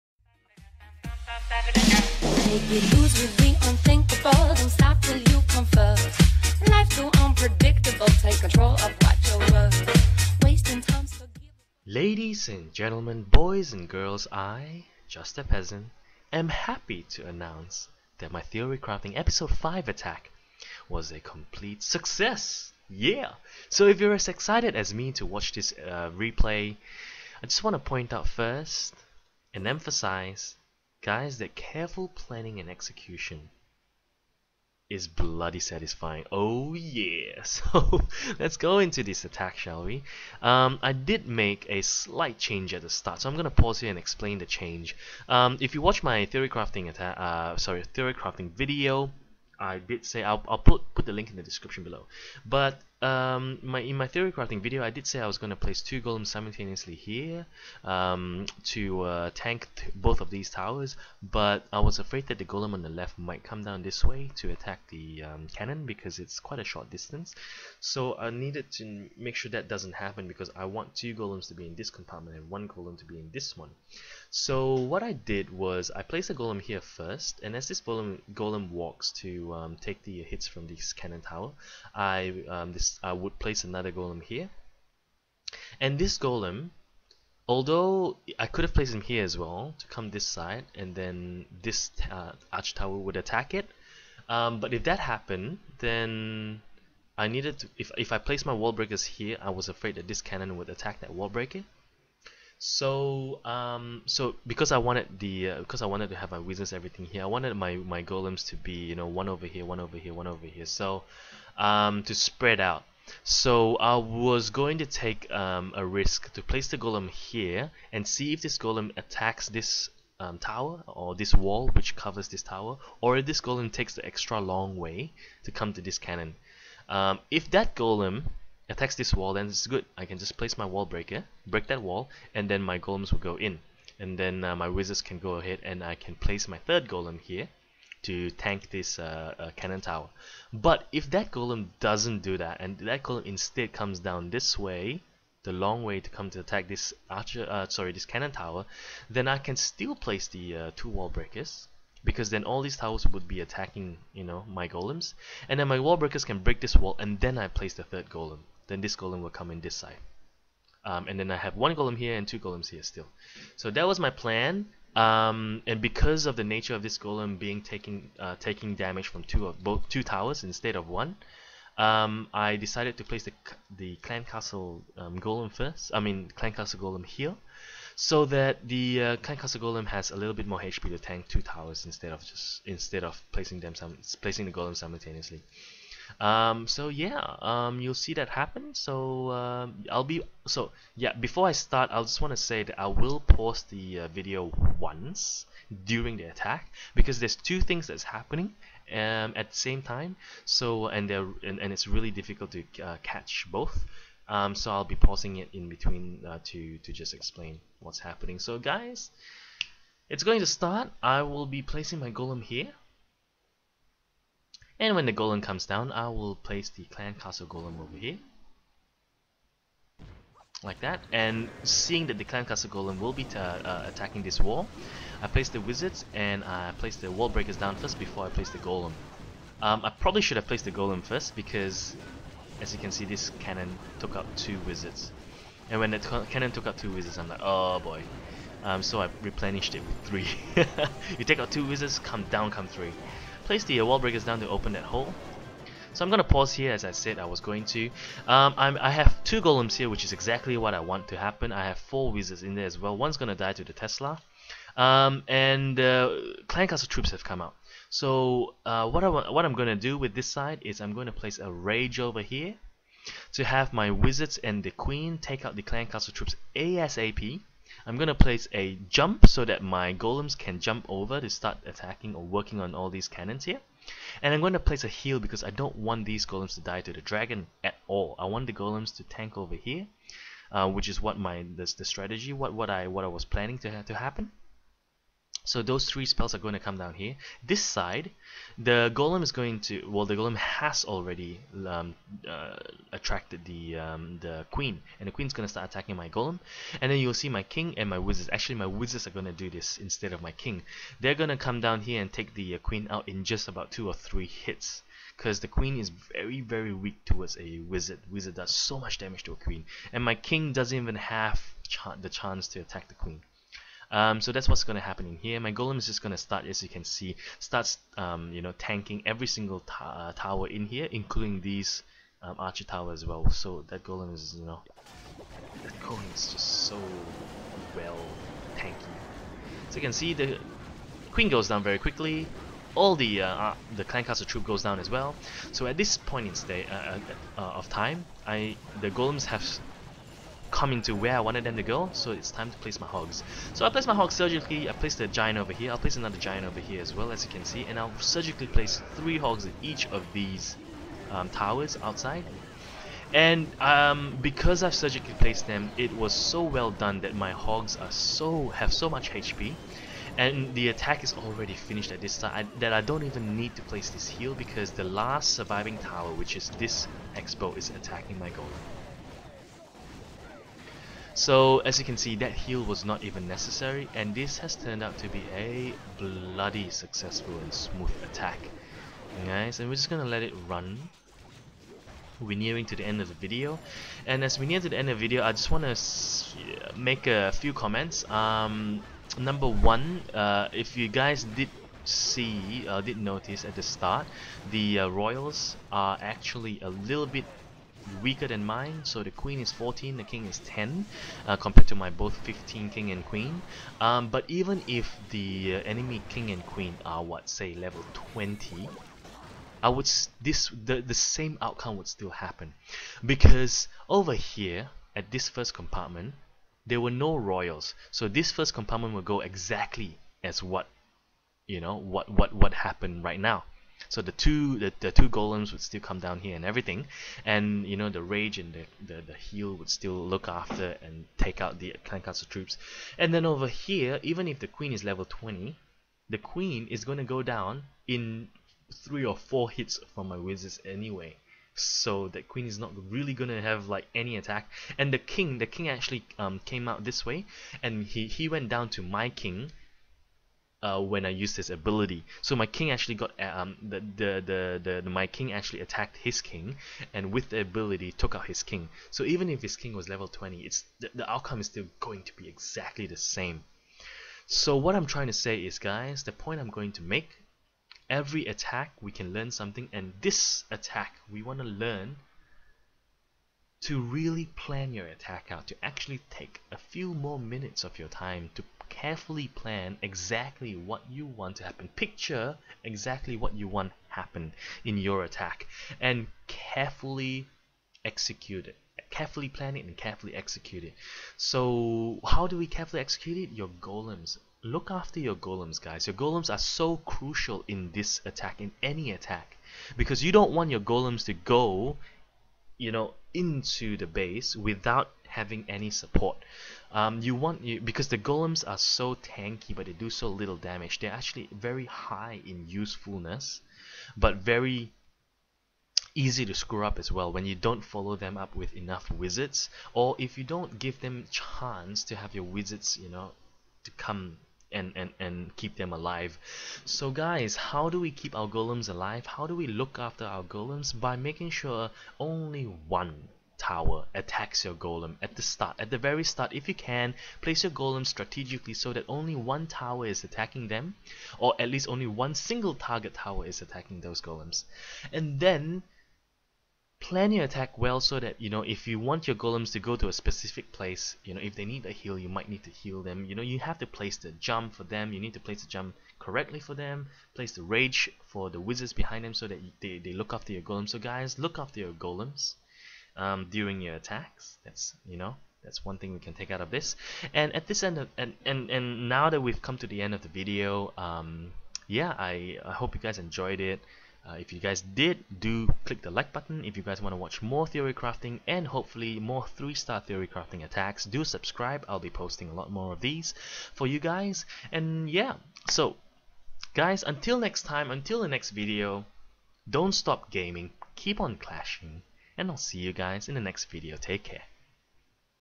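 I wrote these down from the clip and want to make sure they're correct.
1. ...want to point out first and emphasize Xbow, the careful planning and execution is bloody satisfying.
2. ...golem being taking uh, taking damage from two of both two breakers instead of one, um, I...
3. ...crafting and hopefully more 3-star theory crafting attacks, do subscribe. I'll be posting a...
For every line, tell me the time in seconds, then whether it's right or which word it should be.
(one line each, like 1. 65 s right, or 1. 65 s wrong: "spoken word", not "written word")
1. 27 s wrong: "Guys", not "Xbow"
2. 166 s wrong: "towers", not "breakers"
3. 577 s right.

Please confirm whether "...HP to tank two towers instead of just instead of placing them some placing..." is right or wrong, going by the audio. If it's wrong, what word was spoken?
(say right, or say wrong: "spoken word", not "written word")
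right.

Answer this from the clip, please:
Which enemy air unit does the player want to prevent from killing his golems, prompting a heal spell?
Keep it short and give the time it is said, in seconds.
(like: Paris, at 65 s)
dragon, at 276 s.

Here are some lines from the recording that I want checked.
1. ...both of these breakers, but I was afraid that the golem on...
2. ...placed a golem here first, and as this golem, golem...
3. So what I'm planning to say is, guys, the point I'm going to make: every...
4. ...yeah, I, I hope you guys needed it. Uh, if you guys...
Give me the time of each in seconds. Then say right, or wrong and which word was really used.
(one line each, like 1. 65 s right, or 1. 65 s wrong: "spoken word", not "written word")
1. 59 s wrong: "towers", not "breakers"
2. 76 s right
3. 464 s wrong: "trying", not "planning"
4. 571 s wrong: "enjoyed", not "needed".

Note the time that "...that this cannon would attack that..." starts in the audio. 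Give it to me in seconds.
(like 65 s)
99 s.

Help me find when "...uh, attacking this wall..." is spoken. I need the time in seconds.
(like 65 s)
223 s.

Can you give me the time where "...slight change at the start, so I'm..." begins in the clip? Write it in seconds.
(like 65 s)
41 s.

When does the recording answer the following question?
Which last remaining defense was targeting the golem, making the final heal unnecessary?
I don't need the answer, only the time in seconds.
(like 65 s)
366 s.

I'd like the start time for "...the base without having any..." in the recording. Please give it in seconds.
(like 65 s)
503 s.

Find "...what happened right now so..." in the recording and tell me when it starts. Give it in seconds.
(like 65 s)
422 s.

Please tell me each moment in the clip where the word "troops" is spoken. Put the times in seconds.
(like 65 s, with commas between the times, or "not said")
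256 s, 266 s, 334 s, 432 s.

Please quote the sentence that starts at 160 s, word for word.
Um, and then I have one golem here and two golems here still.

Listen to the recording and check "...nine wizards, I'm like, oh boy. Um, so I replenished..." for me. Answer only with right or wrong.
wrong.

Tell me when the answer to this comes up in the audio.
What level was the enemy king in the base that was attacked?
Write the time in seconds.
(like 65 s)
399 s.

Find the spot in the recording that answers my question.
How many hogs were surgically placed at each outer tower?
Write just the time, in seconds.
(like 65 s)
348 s.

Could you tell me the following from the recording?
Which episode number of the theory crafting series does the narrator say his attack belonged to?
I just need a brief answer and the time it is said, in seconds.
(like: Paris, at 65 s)
5, at 19 s.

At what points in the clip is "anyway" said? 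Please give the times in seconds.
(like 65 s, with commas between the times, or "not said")
440 s.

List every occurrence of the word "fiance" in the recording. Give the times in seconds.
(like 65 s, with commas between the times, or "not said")
not said.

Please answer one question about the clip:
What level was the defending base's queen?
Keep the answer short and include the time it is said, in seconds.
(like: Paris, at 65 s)
14, at 399 s.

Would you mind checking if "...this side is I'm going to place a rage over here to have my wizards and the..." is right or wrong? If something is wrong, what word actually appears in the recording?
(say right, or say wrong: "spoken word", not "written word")
right.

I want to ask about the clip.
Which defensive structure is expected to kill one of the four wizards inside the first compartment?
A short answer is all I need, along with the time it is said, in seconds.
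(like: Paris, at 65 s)
Tesla, at 252 s.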